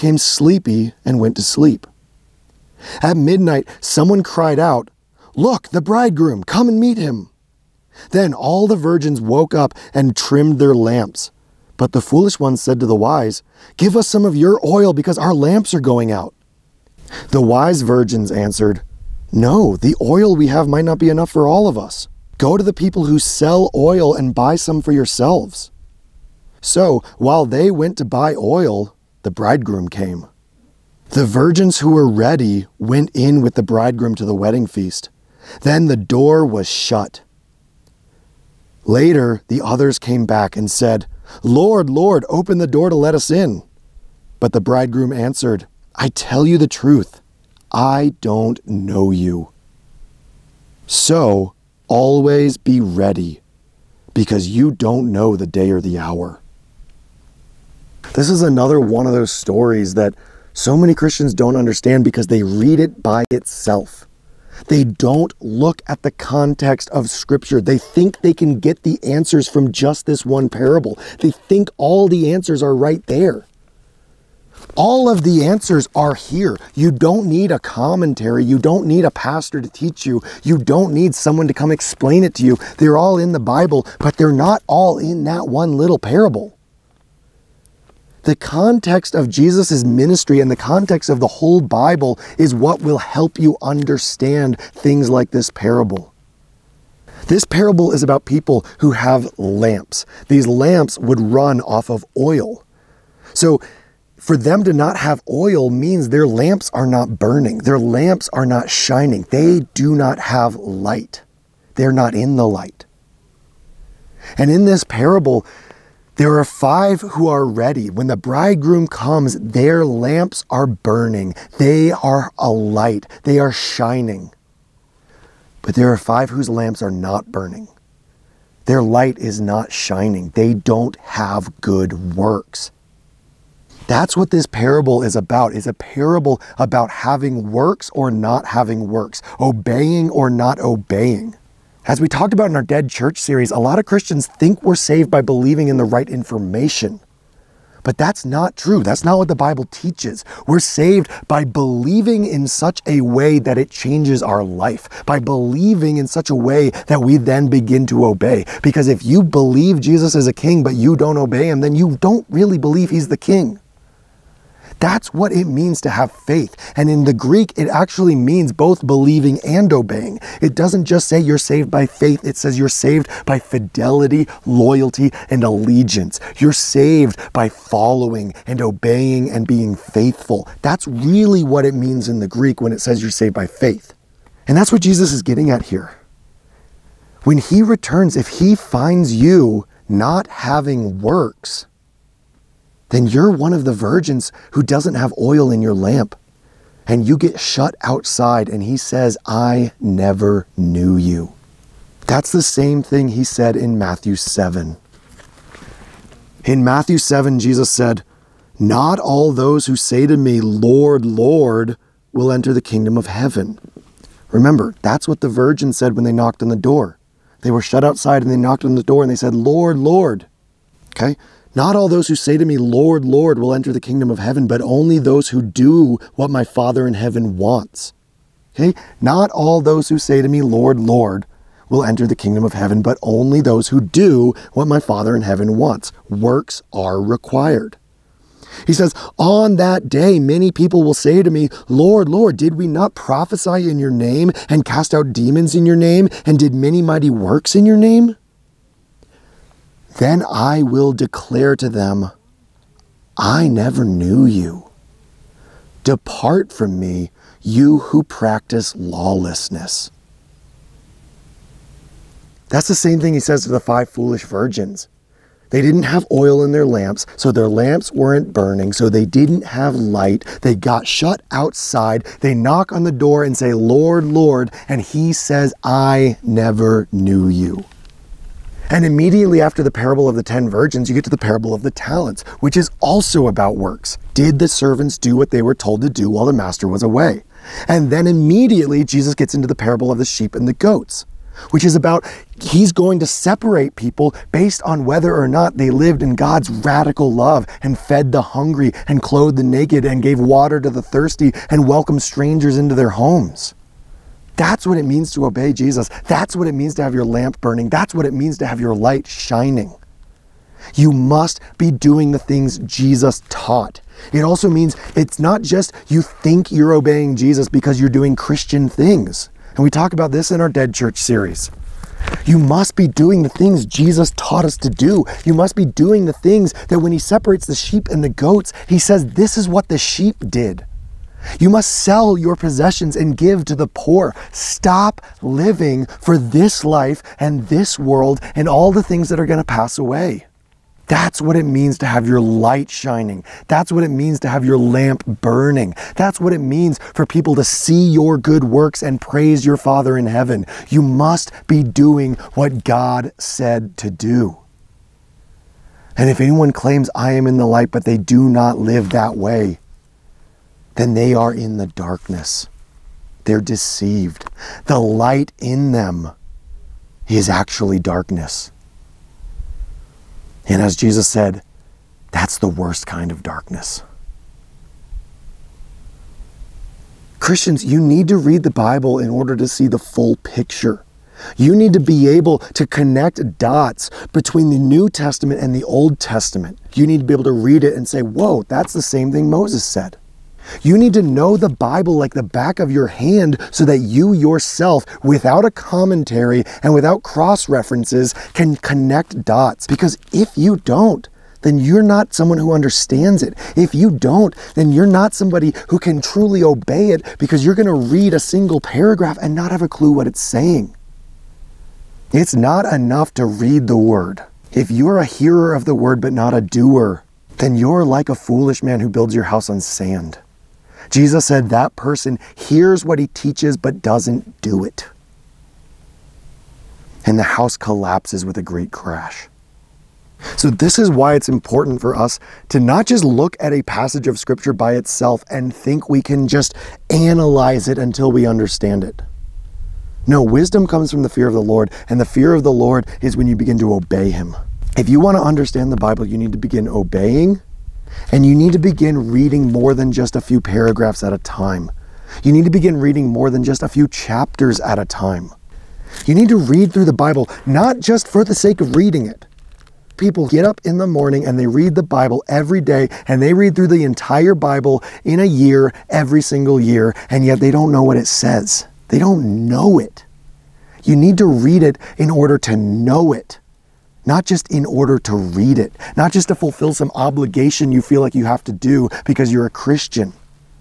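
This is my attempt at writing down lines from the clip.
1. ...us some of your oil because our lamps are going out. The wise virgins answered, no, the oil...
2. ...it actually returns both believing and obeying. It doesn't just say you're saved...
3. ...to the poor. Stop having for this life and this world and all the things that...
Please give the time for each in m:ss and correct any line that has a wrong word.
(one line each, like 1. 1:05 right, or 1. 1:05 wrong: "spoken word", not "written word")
1. 0:13 right
2. 2:47 wrong: "means", not "returns"
3. 5:33 wrong: "living", not "having".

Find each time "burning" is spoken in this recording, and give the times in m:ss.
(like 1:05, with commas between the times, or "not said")
1:47, 2:00, 2:07, 4:28, 5:07, 5:45.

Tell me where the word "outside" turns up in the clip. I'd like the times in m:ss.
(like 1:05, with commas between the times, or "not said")
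3:17, 3:37, 4:31.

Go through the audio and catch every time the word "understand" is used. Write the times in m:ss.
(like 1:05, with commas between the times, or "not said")
1:01, 1:33, 6:42, 7:18, 7:25.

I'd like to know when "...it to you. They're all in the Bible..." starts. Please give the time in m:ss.
1:22.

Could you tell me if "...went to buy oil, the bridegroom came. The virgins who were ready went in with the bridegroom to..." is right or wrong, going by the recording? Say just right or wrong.
right.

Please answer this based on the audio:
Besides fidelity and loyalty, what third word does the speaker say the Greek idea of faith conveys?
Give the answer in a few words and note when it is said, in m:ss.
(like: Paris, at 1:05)
allegiance, at 2:55.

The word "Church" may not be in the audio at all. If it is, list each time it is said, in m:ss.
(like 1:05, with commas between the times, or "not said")
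2:22, 5:20.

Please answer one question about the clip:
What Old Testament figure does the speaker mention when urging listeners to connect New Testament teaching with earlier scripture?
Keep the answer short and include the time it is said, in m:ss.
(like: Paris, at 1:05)
Moses, at 6:29.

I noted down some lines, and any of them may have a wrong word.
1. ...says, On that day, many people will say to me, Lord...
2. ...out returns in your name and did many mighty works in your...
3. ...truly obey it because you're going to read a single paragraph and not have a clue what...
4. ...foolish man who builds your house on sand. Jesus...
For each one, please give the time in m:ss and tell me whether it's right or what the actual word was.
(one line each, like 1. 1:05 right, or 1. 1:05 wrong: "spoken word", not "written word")
1. 3:58 right
2. 4:04 wrong: "demons", not "returns"
3. 6:46 right
4. 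6:58 right.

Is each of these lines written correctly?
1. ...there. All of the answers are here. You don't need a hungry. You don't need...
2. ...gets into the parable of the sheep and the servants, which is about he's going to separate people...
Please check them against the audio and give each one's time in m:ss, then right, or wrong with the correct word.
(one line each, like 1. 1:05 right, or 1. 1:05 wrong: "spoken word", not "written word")
1. 1:13 wrong: "commentary", not "hungry"
2. 4:49 wrong: "goats", not "servants".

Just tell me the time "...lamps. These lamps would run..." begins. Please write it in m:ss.
1:39.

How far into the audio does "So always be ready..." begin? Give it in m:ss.
0:50.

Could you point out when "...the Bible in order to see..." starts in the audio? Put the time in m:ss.
6:18.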